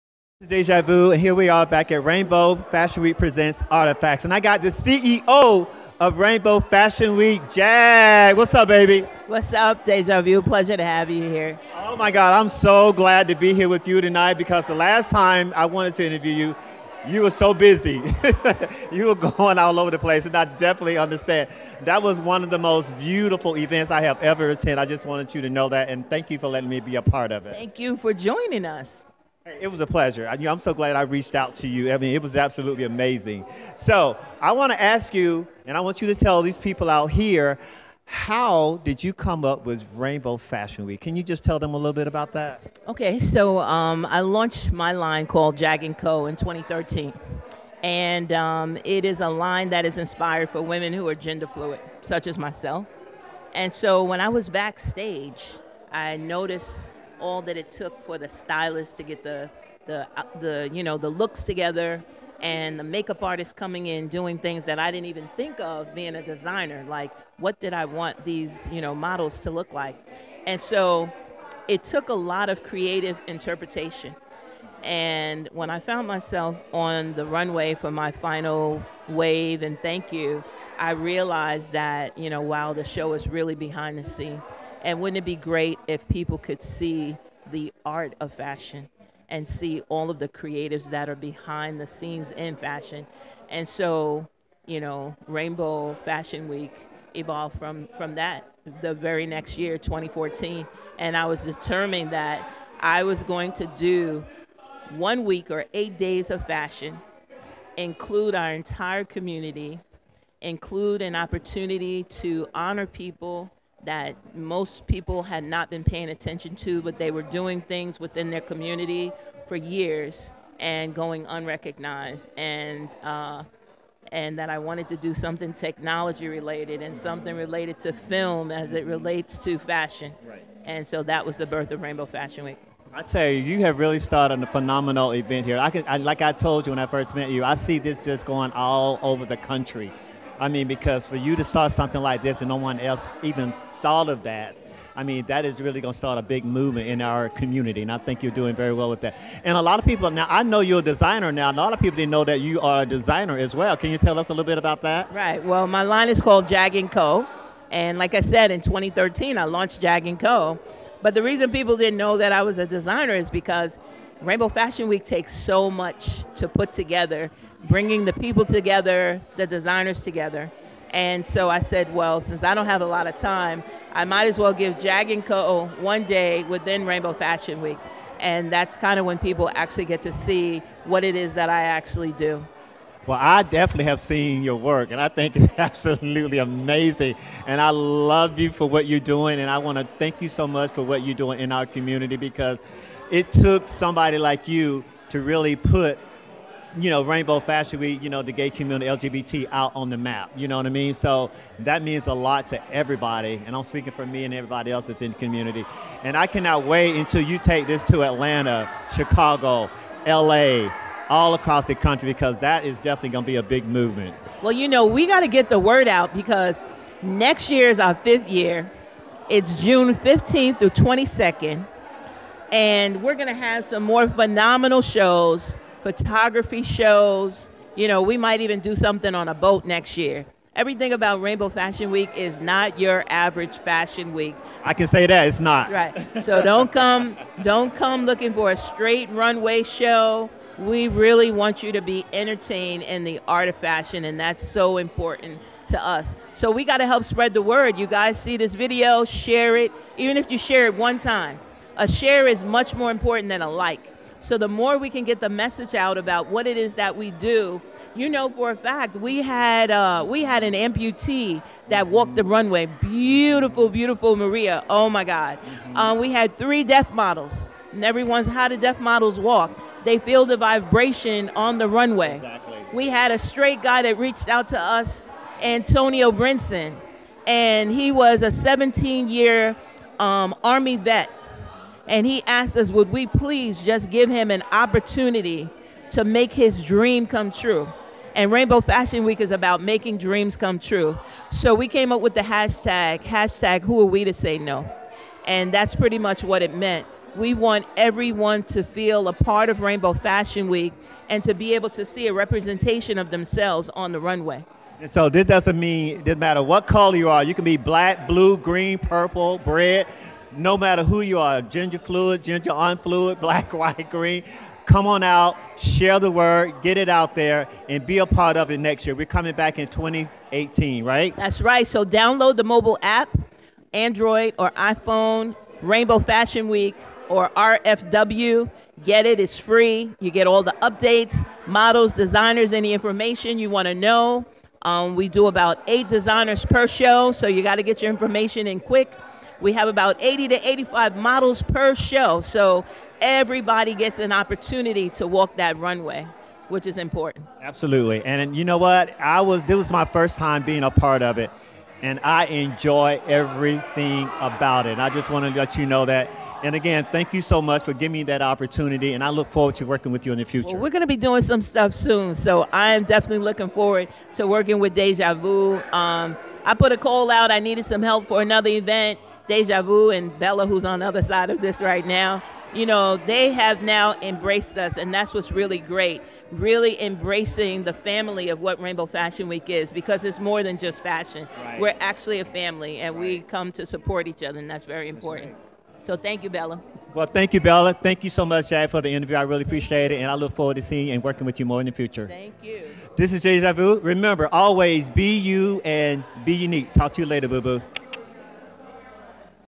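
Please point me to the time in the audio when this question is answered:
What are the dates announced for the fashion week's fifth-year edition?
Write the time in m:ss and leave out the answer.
3:39.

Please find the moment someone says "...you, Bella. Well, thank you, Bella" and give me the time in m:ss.
6:26.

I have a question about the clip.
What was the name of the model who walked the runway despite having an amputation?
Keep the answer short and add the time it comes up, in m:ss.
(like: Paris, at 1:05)
Maria, at 4:24.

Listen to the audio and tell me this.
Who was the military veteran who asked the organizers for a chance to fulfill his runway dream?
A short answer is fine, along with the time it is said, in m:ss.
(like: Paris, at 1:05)
Antonio Brinson, at 4:35.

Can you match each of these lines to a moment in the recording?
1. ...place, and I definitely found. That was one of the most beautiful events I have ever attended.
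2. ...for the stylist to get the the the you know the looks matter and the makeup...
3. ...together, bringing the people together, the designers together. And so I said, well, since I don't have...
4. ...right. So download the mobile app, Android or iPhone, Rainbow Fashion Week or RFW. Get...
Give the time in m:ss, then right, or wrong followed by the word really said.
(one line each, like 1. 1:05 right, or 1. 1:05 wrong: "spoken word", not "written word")
1. 0:19 wrong: "understand", not "found"
2. 0:58 wrong: "together", not "matter"
3. 2:46 right
4. 5:21 right.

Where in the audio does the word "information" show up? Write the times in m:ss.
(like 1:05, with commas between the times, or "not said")
5:32, 5:37.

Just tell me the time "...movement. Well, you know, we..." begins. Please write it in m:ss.
3:33.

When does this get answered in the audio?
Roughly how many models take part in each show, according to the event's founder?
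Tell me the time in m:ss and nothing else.
5:39.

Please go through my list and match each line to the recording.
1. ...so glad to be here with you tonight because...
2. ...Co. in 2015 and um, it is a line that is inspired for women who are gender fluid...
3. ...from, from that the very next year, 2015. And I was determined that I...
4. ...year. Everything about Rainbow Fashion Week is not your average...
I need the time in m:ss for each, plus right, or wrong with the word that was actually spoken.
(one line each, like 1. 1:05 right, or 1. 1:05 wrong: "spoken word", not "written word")
1. 0:12 right
2. 0:45 wrong: "2013", not "2015"
3. 1:37 wrong: "2014", not "2015"
4. 3:49 right.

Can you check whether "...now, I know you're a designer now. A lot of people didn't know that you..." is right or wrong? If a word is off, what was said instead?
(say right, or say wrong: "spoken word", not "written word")
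right.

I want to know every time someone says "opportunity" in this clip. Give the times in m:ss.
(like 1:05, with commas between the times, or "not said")
1:51, 4:44, 5:44, 5:58.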